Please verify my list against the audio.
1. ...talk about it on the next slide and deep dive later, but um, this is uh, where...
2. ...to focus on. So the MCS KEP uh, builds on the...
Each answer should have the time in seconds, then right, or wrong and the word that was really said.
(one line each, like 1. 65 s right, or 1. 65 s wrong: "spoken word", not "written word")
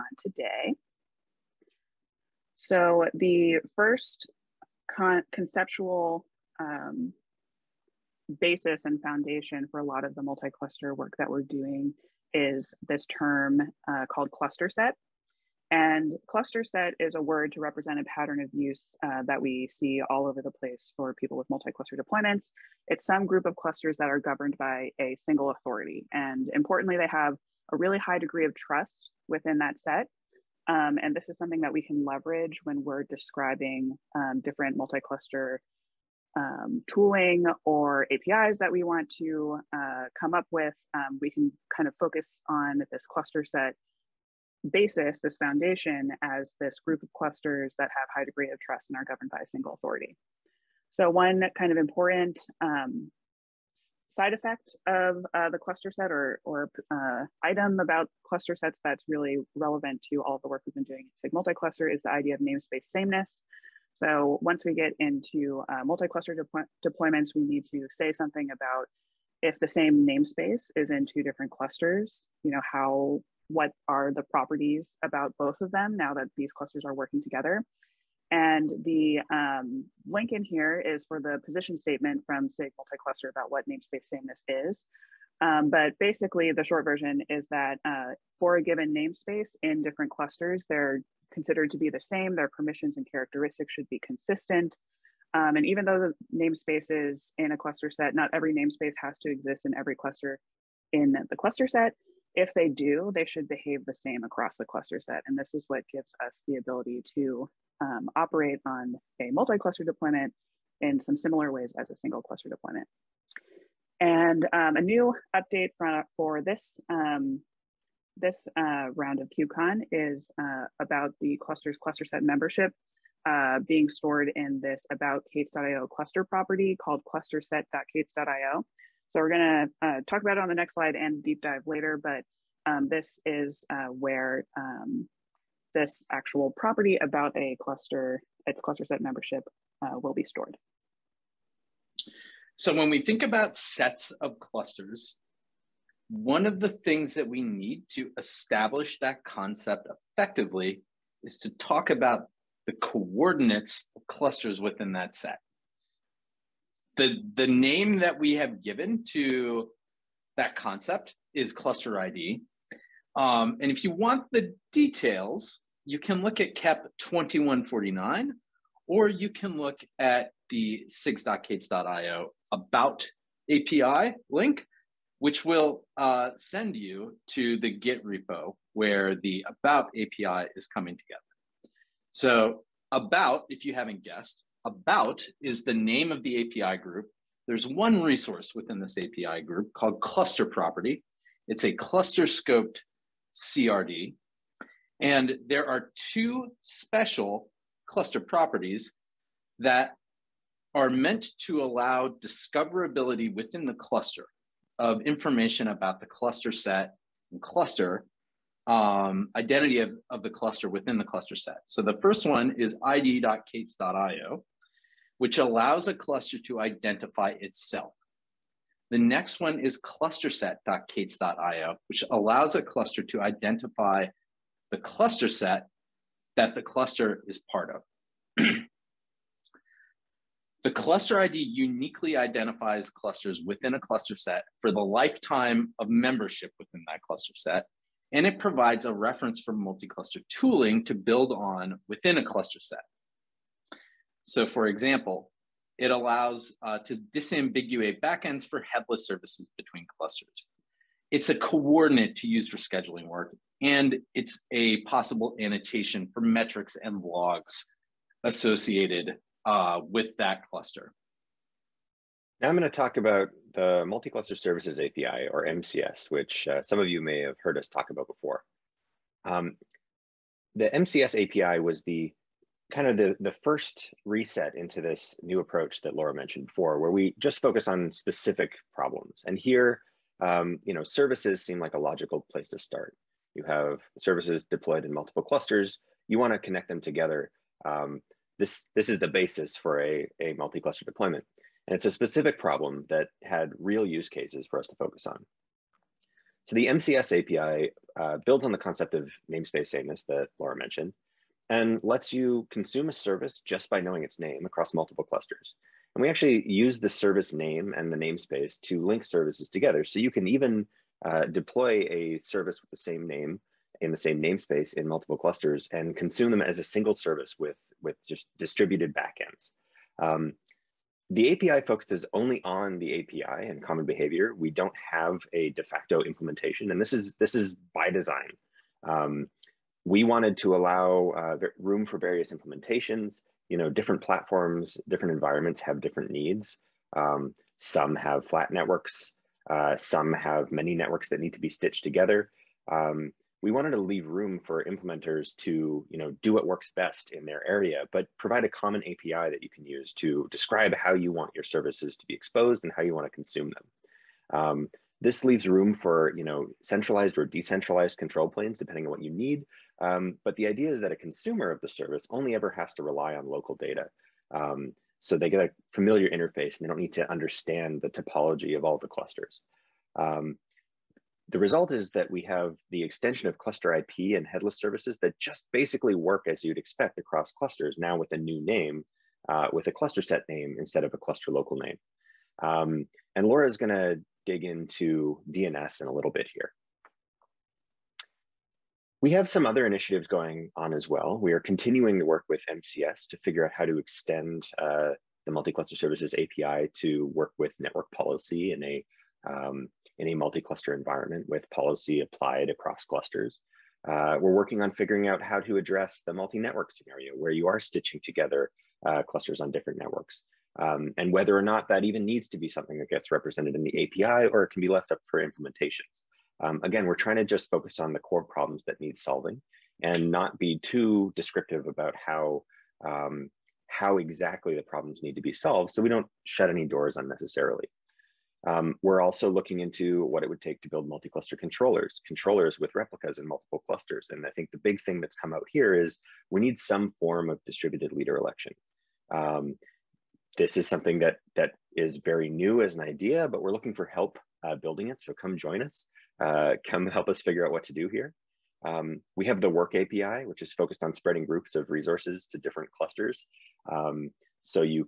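1. 130 s right
2. 294 s wrong: "API", not "KEP".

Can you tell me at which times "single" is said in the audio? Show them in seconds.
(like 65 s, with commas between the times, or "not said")
25 s, 49 s, 111 s, 316 s.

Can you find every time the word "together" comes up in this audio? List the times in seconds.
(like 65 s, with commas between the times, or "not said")
77 s, 180 s, 286 s, 309 s, 341 s, 408 s.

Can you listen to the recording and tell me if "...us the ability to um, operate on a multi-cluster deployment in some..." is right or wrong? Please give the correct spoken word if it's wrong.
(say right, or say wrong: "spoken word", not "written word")
right.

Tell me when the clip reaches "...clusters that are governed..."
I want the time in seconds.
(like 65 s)
23 s.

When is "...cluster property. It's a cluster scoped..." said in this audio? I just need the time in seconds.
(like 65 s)
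189 s.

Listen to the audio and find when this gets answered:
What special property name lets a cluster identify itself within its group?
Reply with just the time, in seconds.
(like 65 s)
212 s.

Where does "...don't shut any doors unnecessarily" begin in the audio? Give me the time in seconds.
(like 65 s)
425 s.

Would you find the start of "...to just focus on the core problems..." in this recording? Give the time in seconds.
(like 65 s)
417 s.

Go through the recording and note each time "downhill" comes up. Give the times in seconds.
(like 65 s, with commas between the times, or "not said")
not said.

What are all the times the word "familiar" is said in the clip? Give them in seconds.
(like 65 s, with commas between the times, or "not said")
365 s.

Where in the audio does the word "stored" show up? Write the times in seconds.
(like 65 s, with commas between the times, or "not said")
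123 s, 140 s.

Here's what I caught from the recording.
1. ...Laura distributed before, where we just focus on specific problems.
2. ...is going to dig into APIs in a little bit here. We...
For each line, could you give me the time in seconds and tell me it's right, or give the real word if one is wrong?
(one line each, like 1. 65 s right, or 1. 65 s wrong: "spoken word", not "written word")
1. 275 s wrong: "mentioned", not "distributed"
2. 383 s wrong: "DNS", not "APIs".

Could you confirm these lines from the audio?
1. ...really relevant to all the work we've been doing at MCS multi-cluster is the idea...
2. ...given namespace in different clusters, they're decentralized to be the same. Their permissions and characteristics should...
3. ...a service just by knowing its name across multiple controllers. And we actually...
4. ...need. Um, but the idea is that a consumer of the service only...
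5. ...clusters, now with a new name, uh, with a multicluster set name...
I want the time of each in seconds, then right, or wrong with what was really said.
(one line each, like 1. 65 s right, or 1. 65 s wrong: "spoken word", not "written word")
1. 59 s wrong: "SIG", not "MCS"
2. 88 s wrong: "considered", not "decentralized"
3. 302 s wrong: "clusters", not "controllers"
4. 359 s right
5. 377 s wrong: "cluster", not "multicluster".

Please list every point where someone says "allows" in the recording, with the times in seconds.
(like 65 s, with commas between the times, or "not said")
201 s, 215 s, 222 s, 245 s, 330 s.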